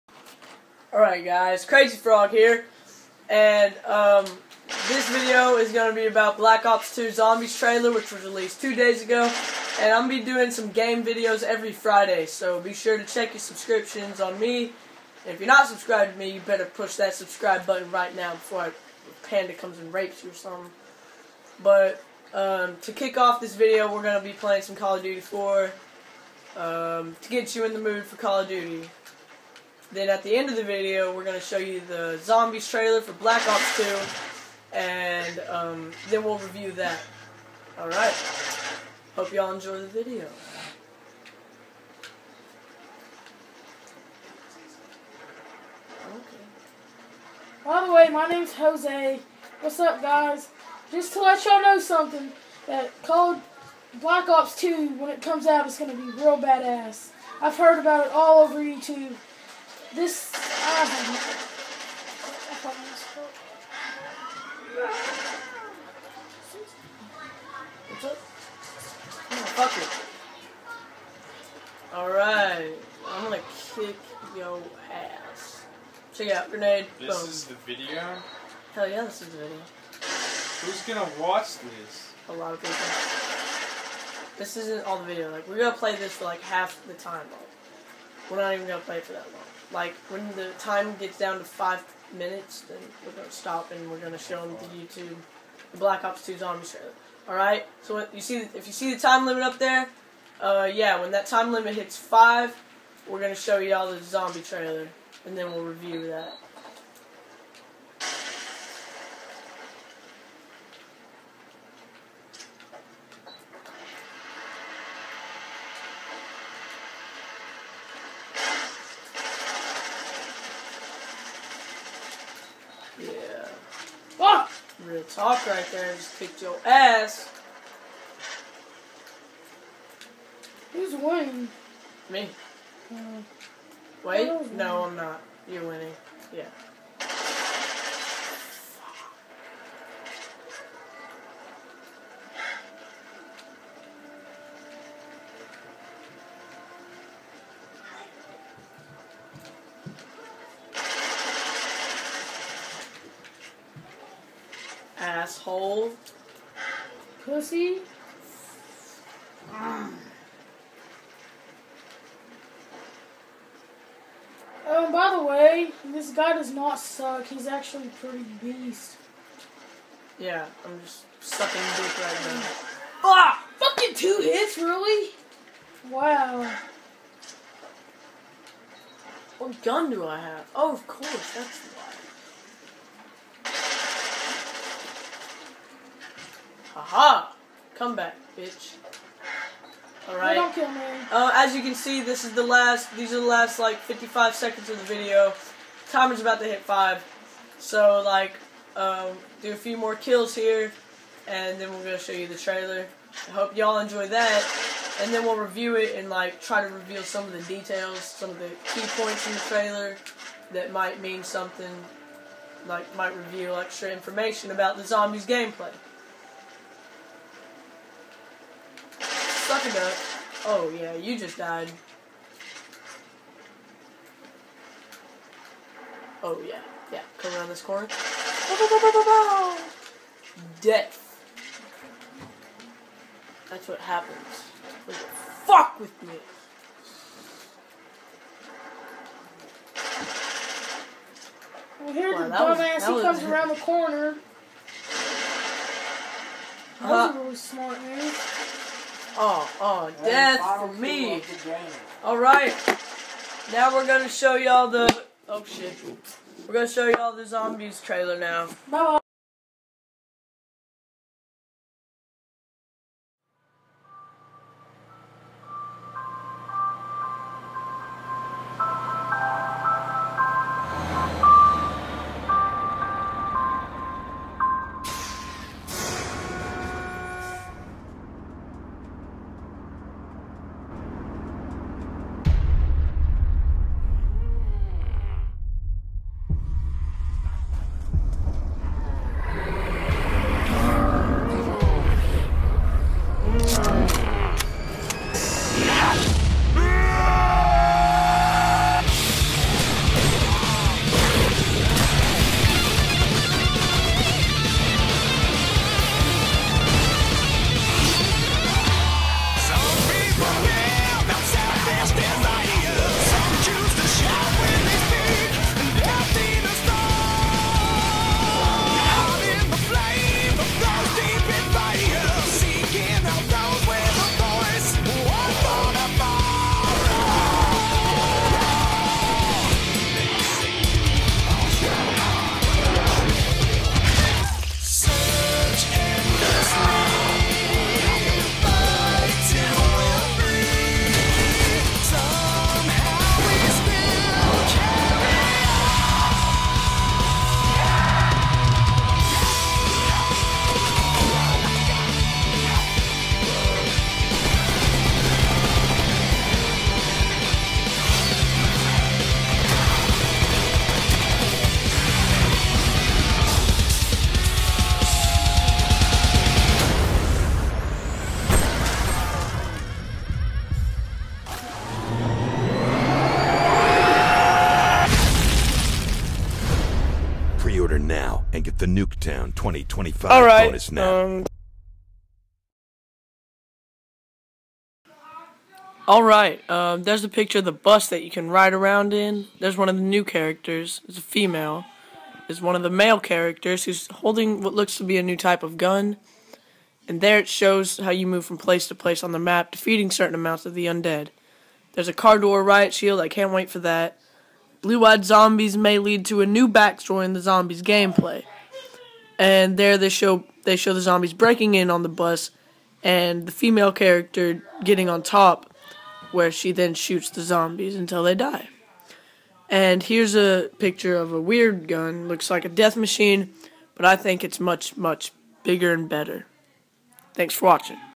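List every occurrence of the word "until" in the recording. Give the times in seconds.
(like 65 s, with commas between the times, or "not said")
417 s.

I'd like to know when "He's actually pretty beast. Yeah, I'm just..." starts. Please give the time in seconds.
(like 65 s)
167 s.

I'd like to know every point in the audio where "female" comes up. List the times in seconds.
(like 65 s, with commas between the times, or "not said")
391 s, 413 s.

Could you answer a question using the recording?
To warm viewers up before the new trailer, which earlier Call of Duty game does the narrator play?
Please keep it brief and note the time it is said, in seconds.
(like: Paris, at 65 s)
Call of Duty 4, at 24 s.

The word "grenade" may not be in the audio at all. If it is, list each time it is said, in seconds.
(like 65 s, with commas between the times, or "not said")
76 s.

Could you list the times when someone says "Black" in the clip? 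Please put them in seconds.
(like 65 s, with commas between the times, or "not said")
6 s, 33 s, 53 s, 95 s.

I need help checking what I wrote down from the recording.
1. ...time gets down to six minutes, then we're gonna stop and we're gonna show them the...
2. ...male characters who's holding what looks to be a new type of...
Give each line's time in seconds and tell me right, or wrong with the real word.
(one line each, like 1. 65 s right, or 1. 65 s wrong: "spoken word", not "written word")
1. 90 s wrong: "five", not "six"
2. 392 s right.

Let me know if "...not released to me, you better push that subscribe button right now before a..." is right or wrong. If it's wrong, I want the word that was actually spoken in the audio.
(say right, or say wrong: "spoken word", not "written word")
wrong: "subscribed", not "released".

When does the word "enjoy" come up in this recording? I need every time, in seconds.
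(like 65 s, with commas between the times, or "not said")
39 s, 203 s.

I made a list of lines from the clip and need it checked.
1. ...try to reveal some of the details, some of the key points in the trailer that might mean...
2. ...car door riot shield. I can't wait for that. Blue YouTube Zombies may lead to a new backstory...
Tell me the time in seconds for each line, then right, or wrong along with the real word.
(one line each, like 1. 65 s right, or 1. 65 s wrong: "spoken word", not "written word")
1. 206 s right
2. 401 s wrong: "Eyed", not "YouTube".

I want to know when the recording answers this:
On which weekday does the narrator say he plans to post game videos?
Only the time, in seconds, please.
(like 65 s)
11 s.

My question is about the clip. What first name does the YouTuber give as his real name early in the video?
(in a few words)
Jose.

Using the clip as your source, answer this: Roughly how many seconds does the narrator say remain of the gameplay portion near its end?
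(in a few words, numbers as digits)
55 seconds.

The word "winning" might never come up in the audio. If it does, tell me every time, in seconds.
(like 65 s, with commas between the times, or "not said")
130 s, 135 s.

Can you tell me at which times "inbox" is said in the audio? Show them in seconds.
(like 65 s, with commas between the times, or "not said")
not said.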